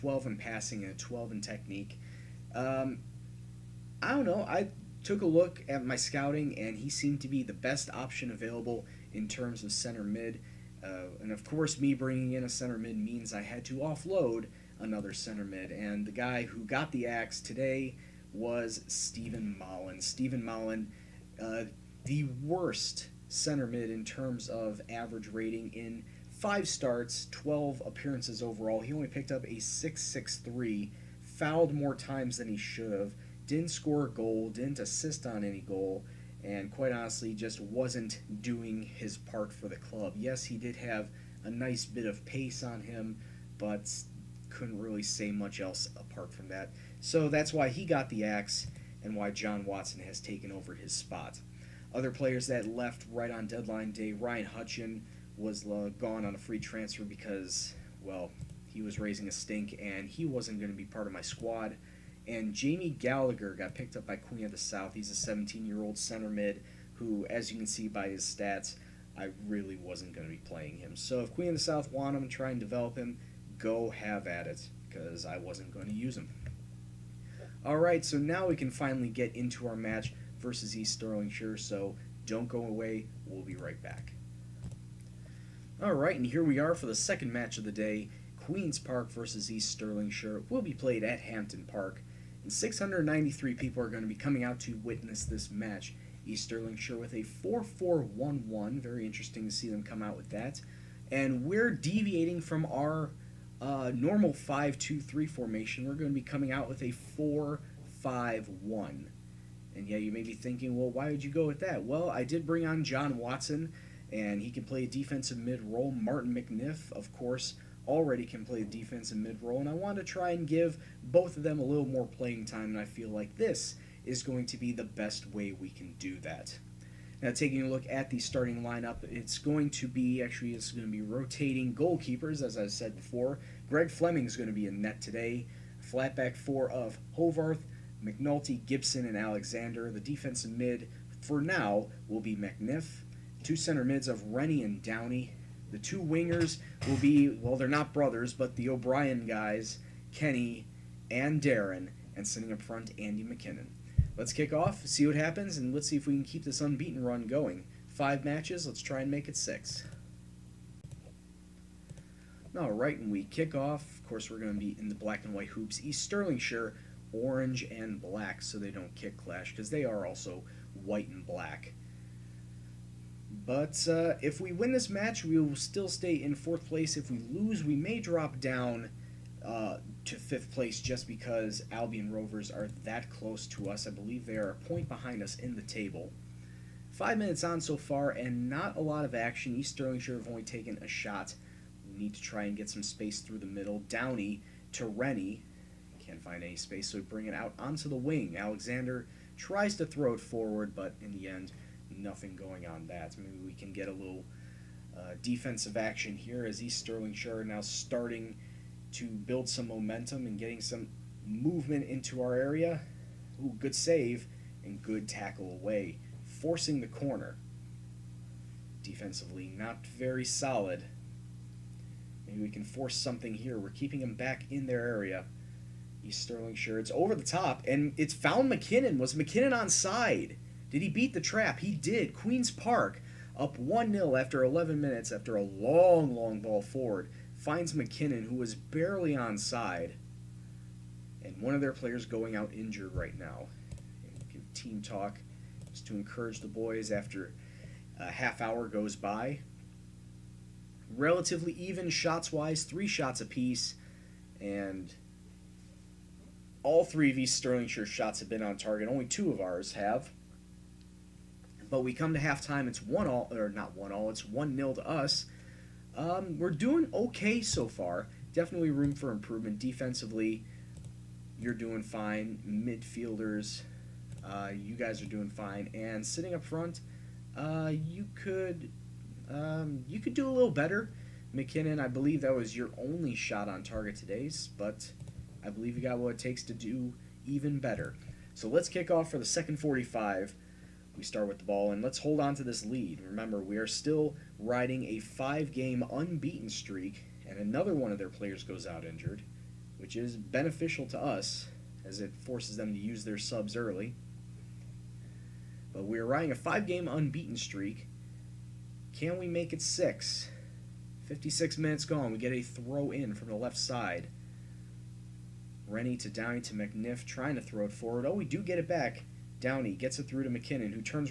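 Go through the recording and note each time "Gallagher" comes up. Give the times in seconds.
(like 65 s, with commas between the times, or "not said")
62 s.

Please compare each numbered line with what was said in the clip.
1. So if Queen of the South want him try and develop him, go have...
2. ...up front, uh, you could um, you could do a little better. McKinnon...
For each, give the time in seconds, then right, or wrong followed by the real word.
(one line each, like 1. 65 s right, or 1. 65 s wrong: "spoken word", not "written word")
1. 70 s right
2. 276 s right.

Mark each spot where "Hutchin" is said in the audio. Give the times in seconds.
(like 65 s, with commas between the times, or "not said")
54 s.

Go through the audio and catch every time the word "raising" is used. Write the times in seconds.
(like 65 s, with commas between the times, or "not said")
58 s.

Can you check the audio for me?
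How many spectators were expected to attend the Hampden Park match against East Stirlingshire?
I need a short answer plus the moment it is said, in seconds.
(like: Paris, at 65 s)
693, at 92 s.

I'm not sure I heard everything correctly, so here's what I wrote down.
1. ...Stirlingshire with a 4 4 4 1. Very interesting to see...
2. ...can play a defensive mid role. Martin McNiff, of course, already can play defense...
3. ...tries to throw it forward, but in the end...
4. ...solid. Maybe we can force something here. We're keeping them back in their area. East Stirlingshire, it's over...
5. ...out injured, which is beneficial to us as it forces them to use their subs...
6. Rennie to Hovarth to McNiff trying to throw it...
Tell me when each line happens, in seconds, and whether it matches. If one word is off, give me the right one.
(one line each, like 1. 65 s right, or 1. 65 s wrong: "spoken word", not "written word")
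1. 96 s wrong: "1", not "4"
2. 114 s right
3. 199 s right
4. 220 s right
5. 298 s right
6. 315 s wrong: "Downey", not "Hovarth".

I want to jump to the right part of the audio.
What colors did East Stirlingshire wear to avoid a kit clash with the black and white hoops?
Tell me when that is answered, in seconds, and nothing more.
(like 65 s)
167 s.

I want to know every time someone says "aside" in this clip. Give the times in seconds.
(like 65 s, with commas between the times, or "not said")
not said.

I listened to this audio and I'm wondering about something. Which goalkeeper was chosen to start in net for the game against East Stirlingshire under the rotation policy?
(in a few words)
Greg Fleming.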